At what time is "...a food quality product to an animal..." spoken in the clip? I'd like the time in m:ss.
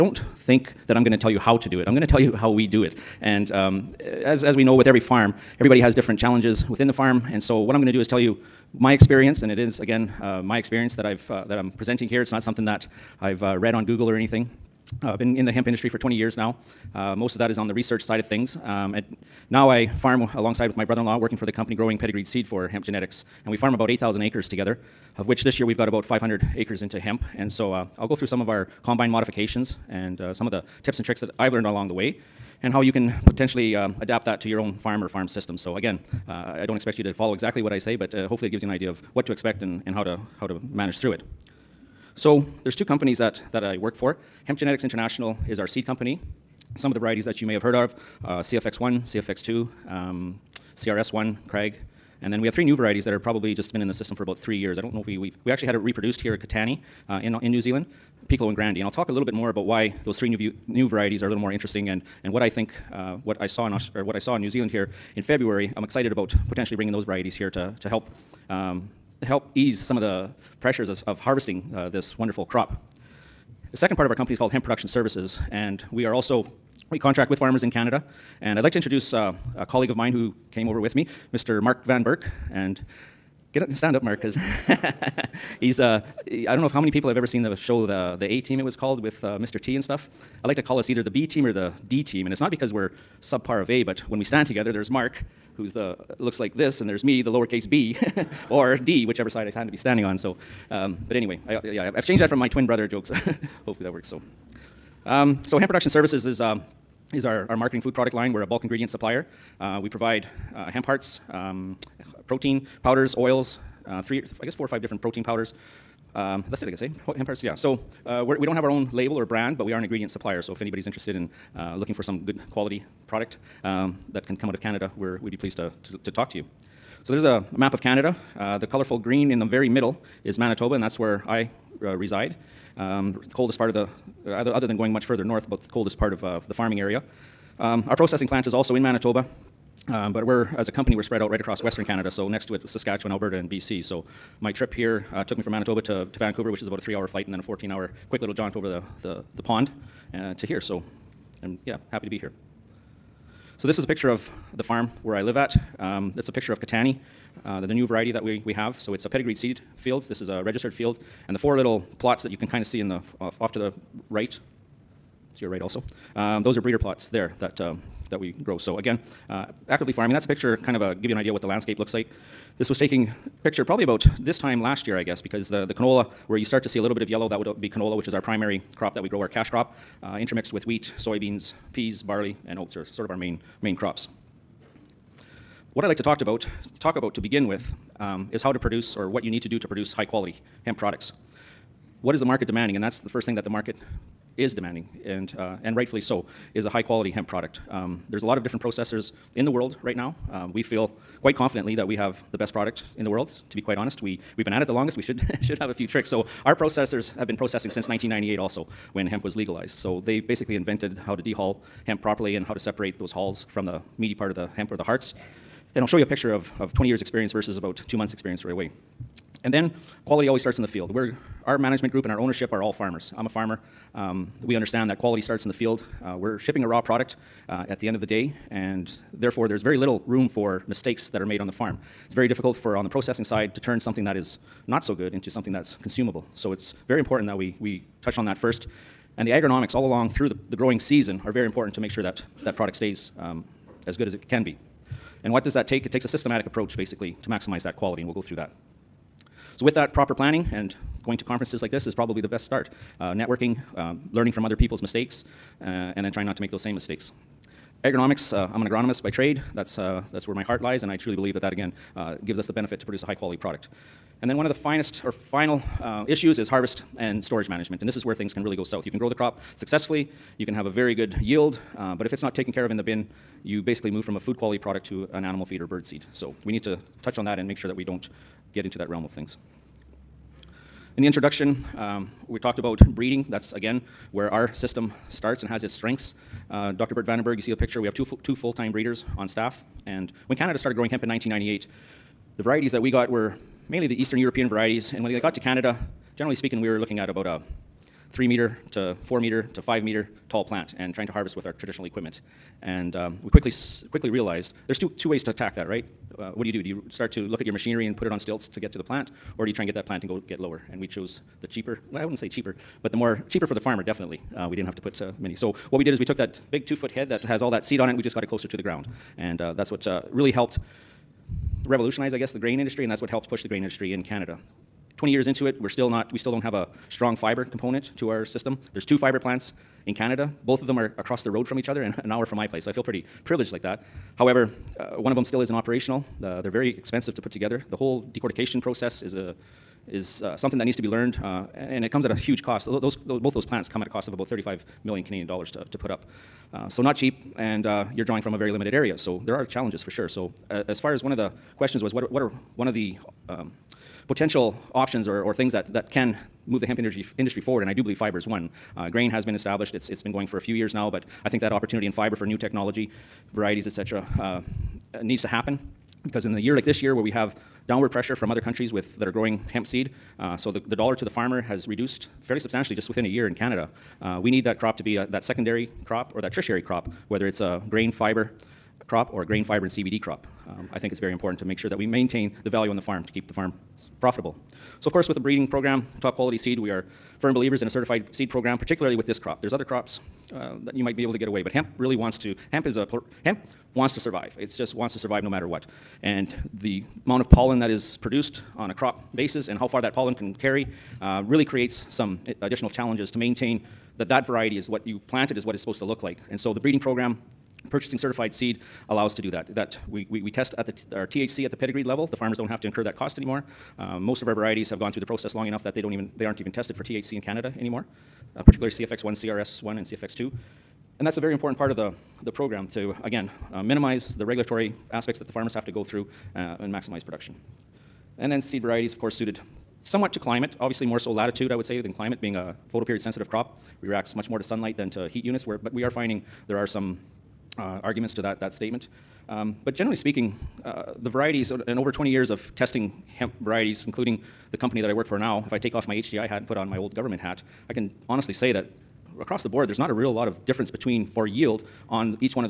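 4:34.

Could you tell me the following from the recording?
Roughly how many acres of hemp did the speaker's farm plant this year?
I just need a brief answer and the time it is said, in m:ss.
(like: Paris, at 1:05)
500, at 0:26.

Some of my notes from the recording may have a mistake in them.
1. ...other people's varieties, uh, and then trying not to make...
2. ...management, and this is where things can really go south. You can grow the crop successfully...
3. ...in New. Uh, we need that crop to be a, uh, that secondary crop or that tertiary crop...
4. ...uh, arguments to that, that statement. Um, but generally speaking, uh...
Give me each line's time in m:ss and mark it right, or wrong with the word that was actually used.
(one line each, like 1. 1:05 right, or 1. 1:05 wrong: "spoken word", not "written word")
1. 4:14 wrong: "mistakes", not "varieties"
2. 4:27 right
3. 6:13 wrong: "Canada", not "New"
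4. 7:17 right.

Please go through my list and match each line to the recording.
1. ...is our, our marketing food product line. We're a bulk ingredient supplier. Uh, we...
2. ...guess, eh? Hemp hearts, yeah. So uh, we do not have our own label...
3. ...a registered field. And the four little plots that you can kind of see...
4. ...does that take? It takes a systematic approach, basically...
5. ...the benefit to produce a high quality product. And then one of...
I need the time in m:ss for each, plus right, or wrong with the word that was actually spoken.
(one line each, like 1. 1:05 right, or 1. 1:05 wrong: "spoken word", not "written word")
1. 1:47 right
2. 1:56 right
3. 2:40 right
4. 4:05 right
5. 4:22 right.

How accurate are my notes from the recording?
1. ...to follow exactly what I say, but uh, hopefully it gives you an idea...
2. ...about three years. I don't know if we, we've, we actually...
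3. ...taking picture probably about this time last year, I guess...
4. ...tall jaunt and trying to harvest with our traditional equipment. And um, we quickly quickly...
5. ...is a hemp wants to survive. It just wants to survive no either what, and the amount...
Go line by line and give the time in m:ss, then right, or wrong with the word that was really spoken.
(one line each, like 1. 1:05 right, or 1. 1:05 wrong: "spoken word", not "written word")
1. 0:37 right
2. 0:54 right
3. 2:52 right
4. 5:00 wrong: "plant", not "jaunt"
5. 6:32 wrong: "matter", not "either".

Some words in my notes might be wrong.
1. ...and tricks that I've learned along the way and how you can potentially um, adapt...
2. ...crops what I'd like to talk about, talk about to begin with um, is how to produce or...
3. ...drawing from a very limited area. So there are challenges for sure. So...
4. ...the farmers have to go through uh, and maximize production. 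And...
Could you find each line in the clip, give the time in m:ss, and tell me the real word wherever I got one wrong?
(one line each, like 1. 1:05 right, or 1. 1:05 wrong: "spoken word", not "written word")
1. 0:30 right
2. 3:03 right
3. 5:48 right
4. 7:05 right.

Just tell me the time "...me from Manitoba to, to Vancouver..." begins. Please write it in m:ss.
2:25.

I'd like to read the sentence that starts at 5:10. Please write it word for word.
And we chose the cheaper, well, I wouldn't say cheaper, but the more cheaper for the farmer, definitely.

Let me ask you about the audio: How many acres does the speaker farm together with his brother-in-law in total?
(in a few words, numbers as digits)
8,000.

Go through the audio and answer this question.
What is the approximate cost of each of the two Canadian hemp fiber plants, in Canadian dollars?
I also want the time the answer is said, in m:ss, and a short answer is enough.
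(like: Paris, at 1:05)
35 million, at 5:44.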